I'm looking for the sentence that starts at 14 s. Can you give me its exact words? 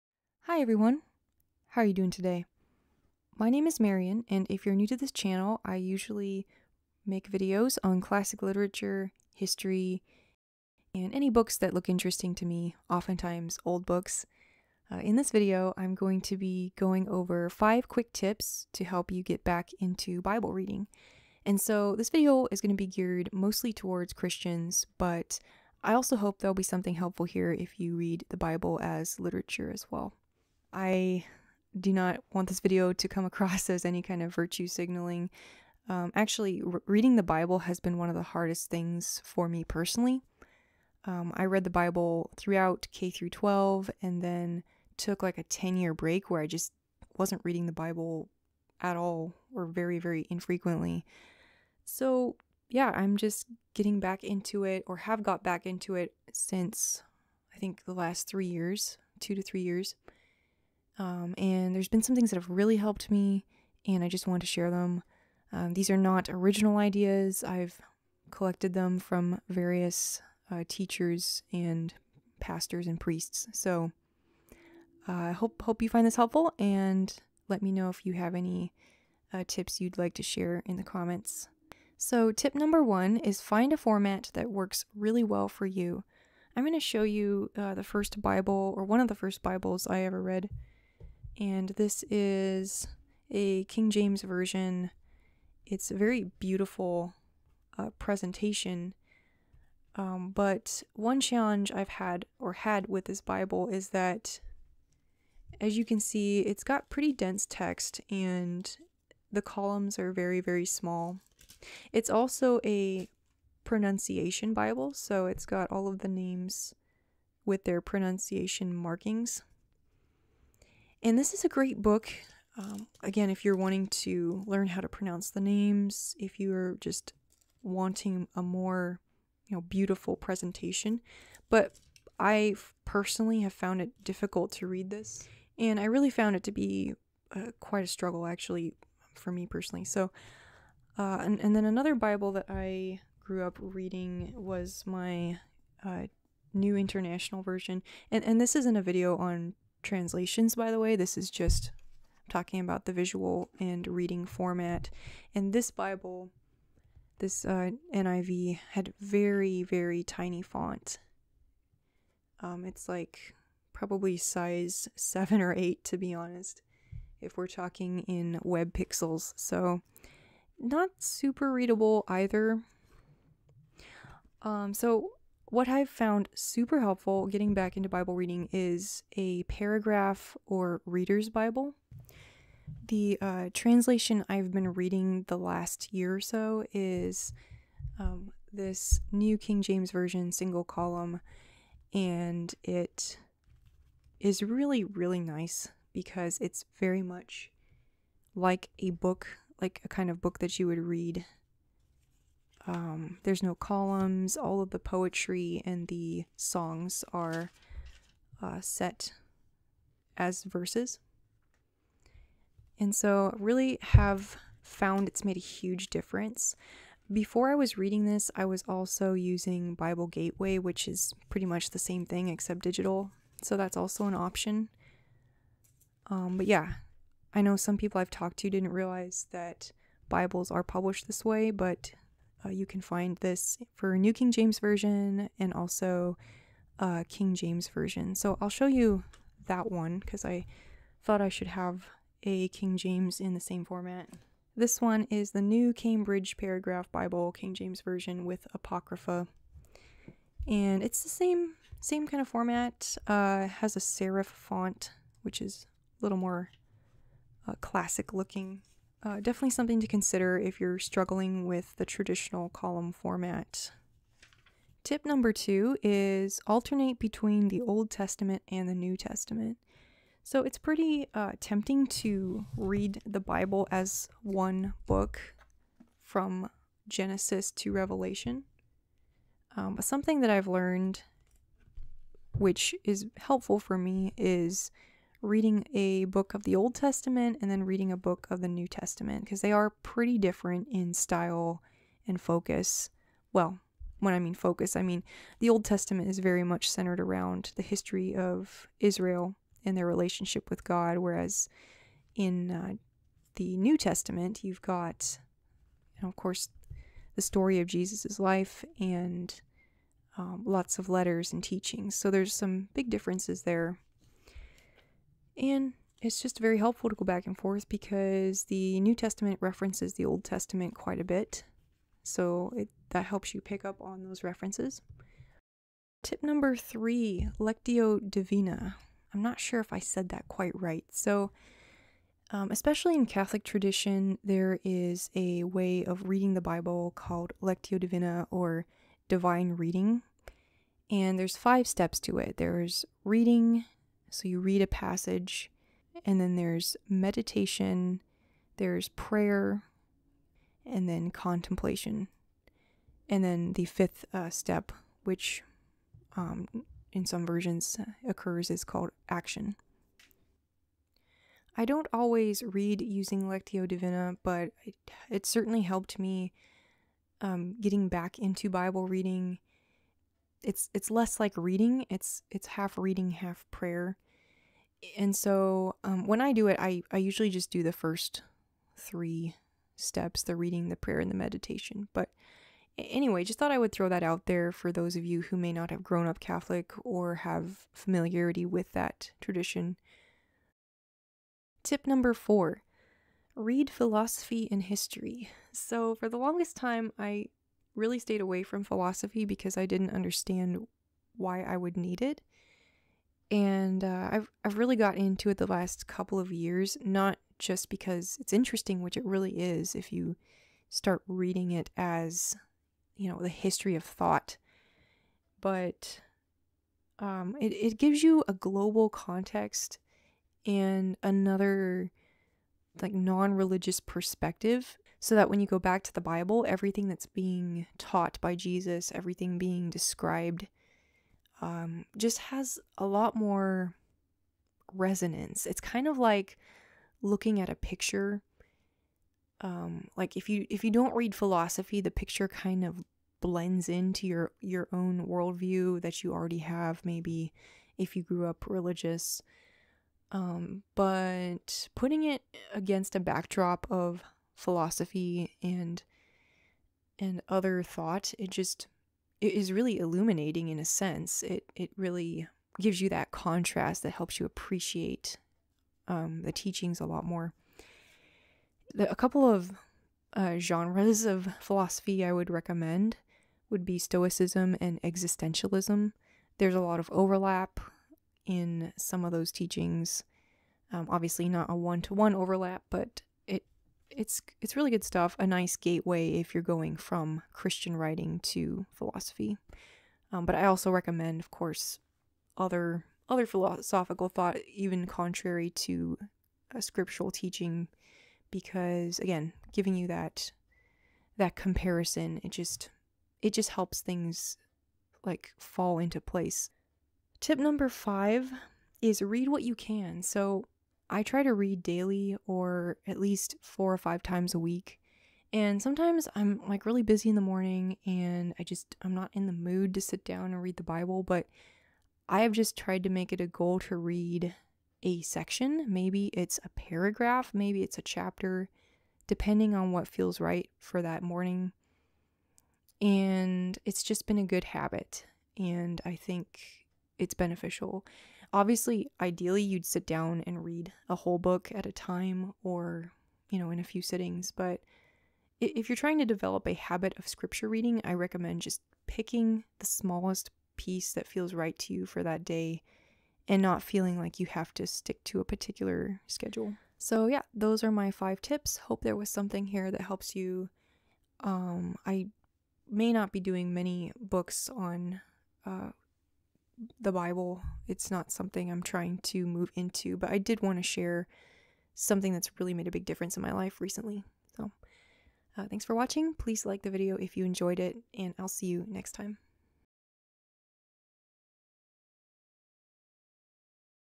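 Uh, in this video, I'm going to be going over five quick tips to help you get back into Bible reading.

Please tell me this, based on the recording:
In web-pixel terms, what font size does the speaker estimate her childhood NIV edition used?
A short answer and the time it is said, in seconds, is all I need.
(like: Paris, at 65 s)
7 or 8, at 164 s.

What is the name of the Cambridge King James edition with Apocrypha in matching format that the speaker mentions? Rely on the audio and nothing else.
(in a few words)
New Cambridge Paragraph Bible.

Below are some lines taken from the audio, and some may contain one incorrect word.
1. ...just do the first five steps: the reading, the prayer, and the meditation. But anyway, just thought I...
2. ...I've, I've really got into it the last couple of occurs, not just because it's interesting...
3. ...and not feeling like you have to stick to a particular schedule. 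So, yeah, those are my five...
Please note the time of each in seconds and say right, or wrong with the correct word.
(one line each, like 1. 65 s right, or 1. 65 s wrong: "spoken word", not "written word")
1. 377 s wrong: "three", not "five"
2. 404 s wrong: "years", not "occurs"
3. 553 s right.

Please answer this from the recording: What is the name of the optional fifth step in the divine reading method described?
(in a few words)
action.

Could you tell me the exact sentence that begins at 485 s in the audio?
A nice gateway if you're going from Christian writing to philosophy.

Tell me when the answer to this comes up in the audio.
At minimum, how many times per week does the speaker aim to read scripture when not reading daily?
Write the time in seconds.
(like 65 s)
513 s.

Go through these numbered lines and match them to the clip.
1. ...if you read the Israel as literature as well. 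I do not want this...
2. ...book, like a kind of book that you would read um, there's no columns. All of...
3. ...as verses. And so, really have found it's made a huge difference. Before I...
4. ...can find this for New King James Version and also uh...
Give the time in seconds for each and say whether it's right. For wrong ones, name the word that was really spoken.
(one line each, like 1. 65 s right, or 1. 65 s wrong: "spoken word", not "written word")
1. 27 s wrong: "Bible", not "Israel"
2. 198 s right
3. 210 s right
4. 232 s right.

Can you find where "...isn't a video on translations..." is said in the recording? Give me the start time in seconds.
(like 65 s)
148 s.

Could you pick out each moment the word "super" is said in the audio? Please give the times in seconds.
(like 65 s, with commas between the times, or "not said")
170 s, 176 s.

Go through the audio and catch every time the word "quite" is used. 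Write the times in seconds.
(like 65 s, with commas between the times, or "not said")
137 s, 320 s, 330 s.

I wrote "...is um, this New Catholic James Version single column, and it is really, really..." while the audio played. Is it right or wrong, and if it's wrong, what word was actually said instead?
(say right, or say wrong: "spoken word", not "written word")
wrong: "King", not "Catholic".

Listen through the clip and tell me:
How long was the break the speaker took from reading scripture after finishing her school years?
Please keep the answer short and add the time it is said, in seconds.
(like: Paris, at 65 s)
10 years, at 45 s.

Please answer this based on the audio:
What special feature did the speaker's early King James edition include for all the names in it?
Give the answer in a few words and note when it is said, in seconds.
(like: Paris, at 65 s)
pronunciation markings, at 117 s.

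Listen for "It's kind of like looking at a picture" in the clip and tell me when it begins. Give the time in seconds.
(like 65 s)
435 s.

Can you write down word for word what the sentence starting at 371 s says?
It's it's half reading, half prayer.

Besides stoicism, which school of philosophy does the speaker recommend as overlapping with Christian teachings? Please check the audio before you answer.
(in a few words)
existentialism.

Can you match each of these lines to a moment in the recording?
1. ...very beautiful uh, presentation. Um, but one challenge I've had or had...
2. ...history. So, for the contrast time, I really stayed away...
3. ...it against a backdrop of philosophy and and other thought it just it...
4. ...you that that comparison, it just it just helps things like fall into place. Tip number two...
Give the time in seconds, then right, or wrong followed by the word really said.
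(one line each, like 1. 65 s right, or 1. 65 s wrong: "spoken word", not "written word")
1. 95 s right
2. 394 s wrong: "longest", not "contrast"
3. 452 s right
4. 499 s wrong: "five", not "two".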